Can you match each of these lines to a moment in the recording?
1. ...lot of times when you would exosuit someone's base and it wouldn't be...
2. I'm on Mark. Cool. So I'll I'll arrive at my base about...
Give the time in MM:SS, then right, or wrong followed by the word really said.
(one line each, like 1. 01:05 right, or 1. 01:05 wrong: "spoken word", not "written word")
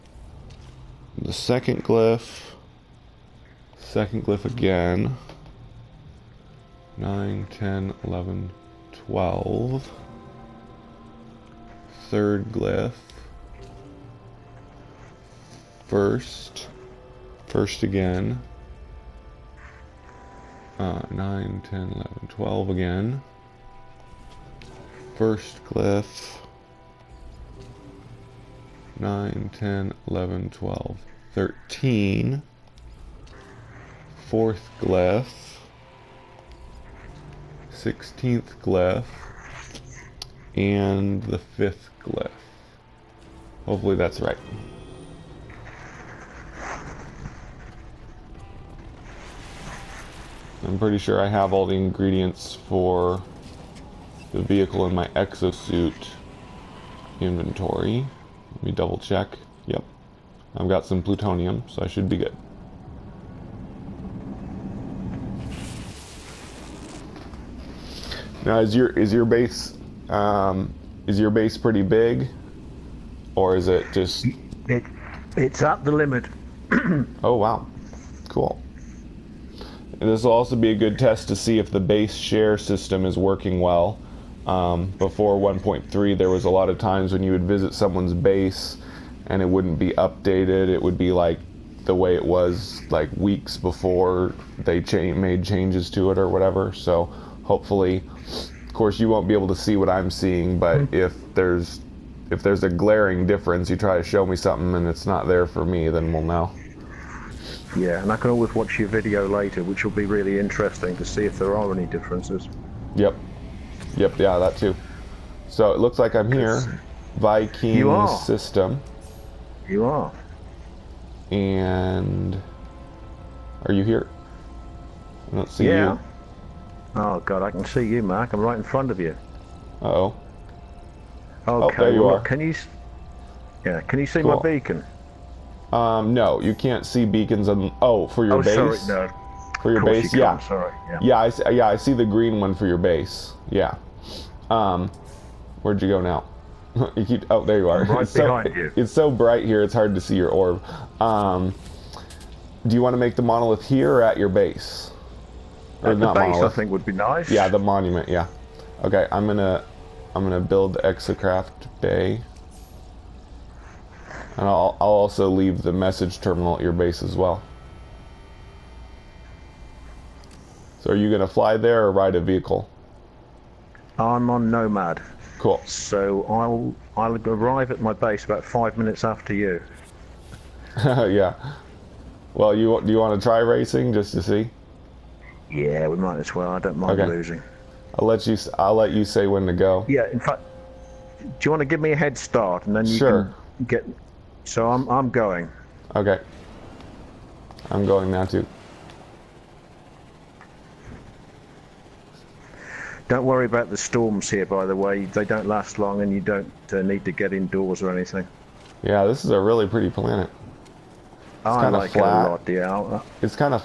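1. 01:26 wrong: "visit", not "exosuit"
2. 02:53 wrong: "Nomad", not "Mark".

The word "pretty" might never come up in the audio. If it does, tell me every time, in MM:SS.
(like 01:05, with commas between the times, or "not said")
00:50, 01:11, 03:29.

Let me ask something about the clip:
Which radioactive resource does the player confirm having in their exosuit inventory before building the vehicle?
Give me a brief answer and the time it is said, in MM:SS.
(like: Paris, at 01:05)
Plutonium, at 01:01.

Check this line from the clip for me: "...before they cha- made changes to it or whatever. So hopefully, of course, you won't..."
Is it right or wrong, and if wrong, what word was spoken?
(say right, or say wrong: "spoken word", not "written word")
right.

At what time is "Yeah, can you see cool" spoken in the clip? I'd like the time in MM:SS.
02:13.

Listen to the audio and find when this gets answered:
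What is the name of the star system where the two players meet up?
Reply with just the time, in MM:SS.
01:57.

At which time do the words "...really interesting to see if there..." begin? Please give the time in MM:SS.
01:50.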